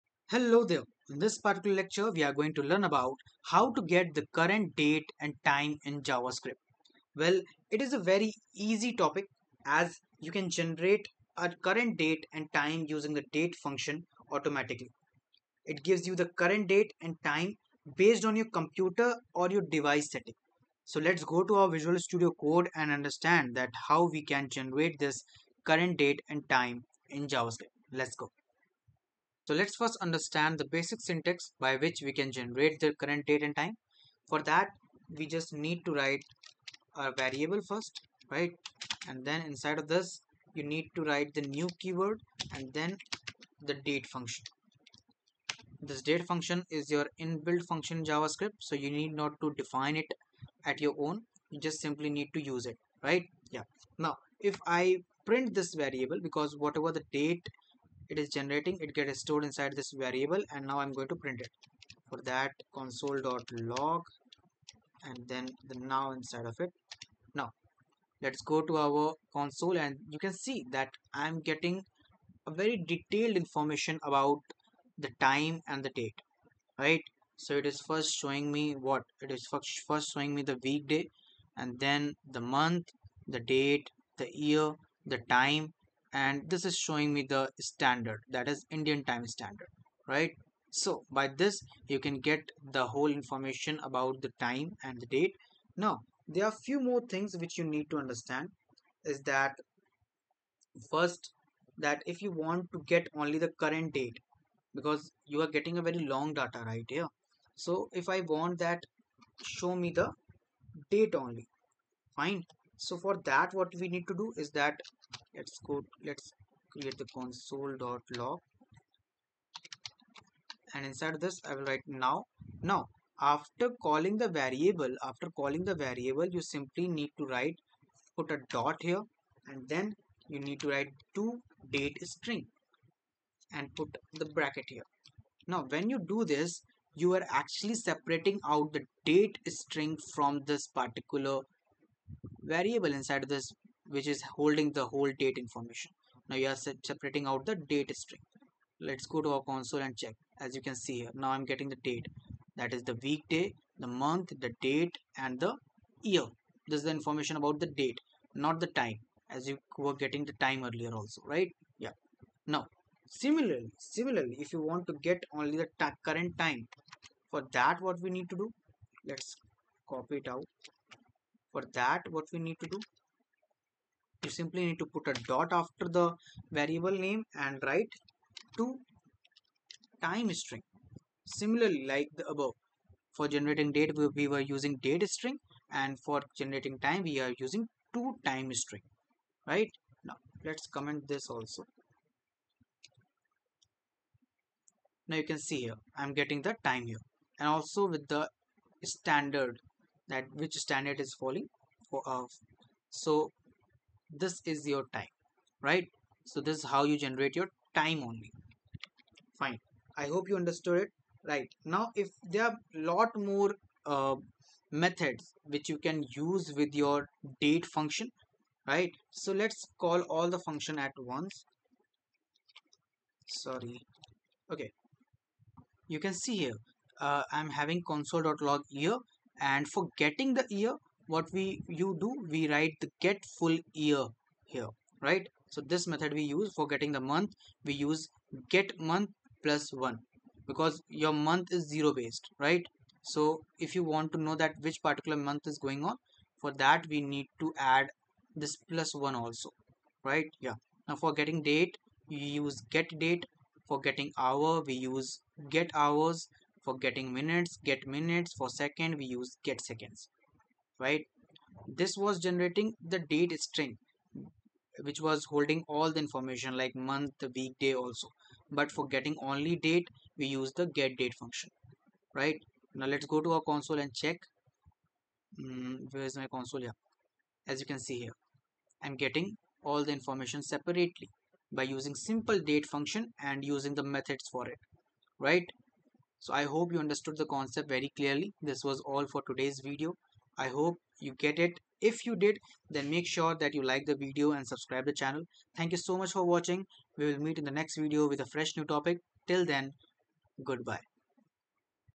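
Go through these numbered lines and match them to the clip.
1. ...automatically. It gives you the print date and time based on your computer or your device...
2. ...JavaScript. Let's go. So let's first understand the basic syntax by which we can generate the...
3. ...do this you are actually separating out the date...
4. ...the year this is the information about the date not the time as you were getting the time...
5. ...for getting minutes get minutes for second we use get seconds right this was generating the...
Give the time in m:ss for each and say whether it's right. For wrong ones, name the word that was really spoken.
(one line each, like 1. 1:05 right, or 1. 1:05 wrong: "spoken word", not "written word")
1. 0:14 wrong: "current", not "print"
2. 0:27 right
3. 2:15 right
4. 2:35 right
5. 4:16 right.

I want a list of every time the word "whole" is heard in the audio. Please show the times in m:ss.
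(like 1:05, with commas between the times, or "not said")
1:32, 2:24.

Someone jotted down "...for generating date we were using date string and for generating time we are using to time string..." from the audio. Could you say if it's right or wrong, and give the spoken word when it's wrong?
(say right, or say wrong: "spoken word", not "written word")
right.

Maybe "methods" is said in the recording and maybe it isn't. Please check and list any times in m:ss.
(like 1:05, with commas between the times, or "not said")
3:34, 3:55, 4:43.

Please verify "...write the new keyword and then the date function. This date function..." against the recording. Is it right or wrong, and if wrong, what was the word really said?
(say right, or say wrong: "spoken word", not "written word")
right.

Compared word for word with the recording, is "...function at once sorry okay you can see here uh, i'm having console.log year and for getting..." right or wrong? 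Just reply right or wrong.
right.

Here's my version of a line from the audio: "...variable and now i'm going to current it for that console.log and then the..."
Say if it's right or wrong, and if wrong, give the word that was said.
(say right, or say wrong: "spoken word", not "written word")
wrong: "print", not "current".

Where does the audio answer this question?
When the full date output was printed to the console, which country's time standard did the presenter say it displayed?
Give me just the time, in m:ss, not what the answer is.
1:28.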